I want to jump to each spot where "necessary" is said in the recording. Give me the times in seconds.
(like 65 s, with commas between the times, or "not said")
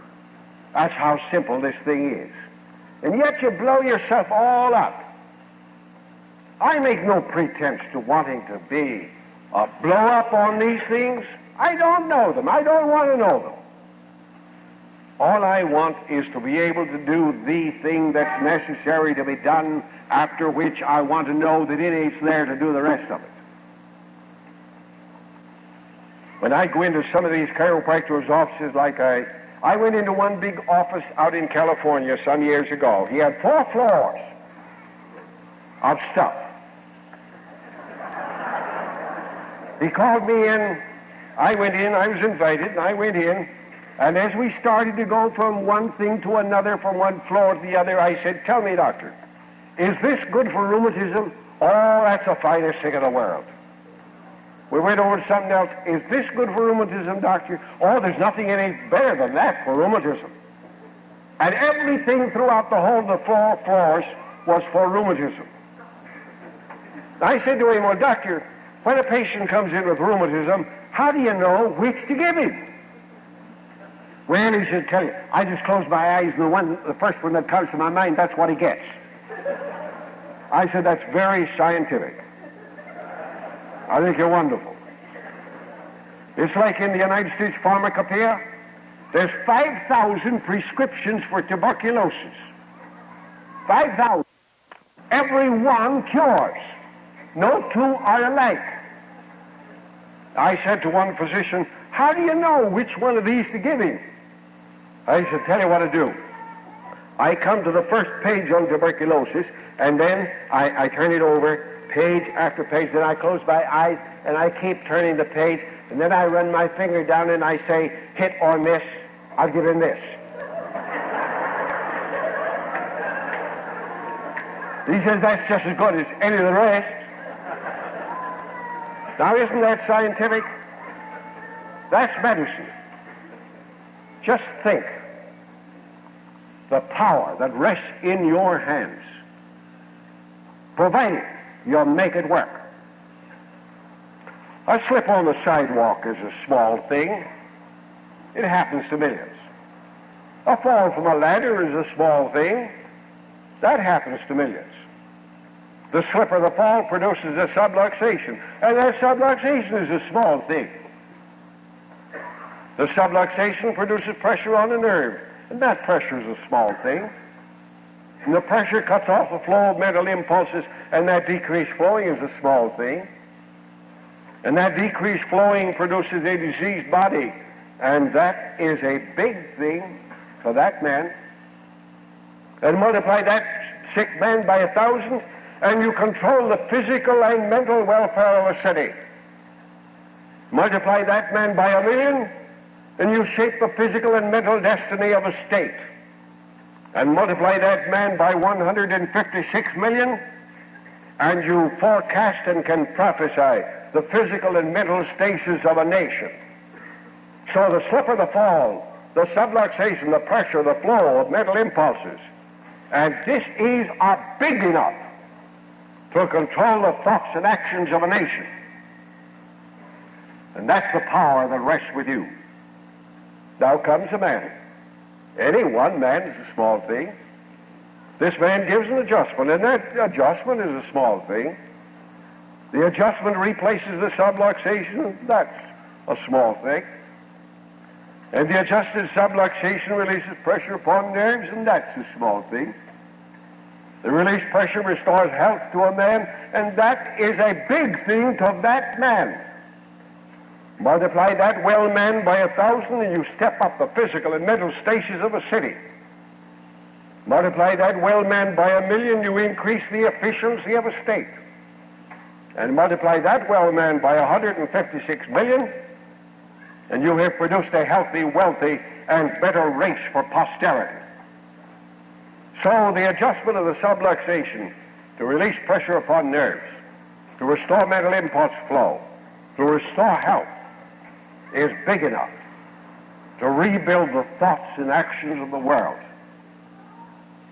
18 s.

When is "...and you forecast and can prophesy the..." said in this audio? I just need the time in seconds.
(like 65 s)
201 s.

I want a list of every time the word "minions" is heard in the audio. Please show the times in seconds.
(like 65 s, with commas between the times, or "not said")
not said.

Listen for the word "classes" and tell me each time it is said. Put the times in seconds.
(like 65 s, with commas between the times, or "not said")
not said.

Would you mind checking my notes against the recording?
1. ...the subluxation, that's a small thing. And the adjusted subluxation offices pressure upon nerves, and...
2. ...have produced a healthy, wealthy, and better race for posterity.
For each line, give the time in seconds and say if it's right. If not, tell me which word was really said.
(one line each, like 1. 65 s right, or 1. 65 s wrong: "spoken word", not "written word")
1. 233 s wrong: "releases", not "offices"
2. 267 s right.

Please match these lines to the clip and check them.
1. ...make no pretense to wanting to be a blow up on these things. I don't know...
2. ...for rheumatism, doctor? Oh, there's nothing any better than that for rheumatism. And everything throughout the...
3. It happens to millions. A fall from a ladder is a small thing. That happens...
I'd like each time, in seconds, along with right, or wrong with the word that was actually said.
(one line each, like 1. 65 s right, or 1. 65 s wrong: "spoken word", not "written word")
1. 6 s right
2. 56 s right
3. 148 s right.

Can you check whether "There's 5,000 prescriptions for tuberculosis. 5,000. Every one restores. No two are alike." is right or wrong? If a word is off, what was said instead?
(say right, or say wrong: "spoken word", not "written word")
wrong: "cures", not "restores".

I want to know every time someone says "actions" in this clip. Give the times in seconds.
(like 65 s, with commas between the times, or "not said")
217 s, 284 s.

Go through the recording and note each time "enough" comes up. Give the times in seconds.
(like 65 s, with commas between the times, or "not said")
214 s, 282 s.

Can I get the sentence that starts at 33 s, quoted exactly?
He had four floors of stuff.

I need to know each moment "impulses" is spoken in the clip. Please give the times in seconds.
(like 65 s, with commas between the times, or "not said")
170 s, 211 s, 278 s.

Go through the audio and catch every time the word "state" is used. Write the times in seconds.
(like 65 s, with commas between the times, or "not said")
87 s, 195 s, 261 s.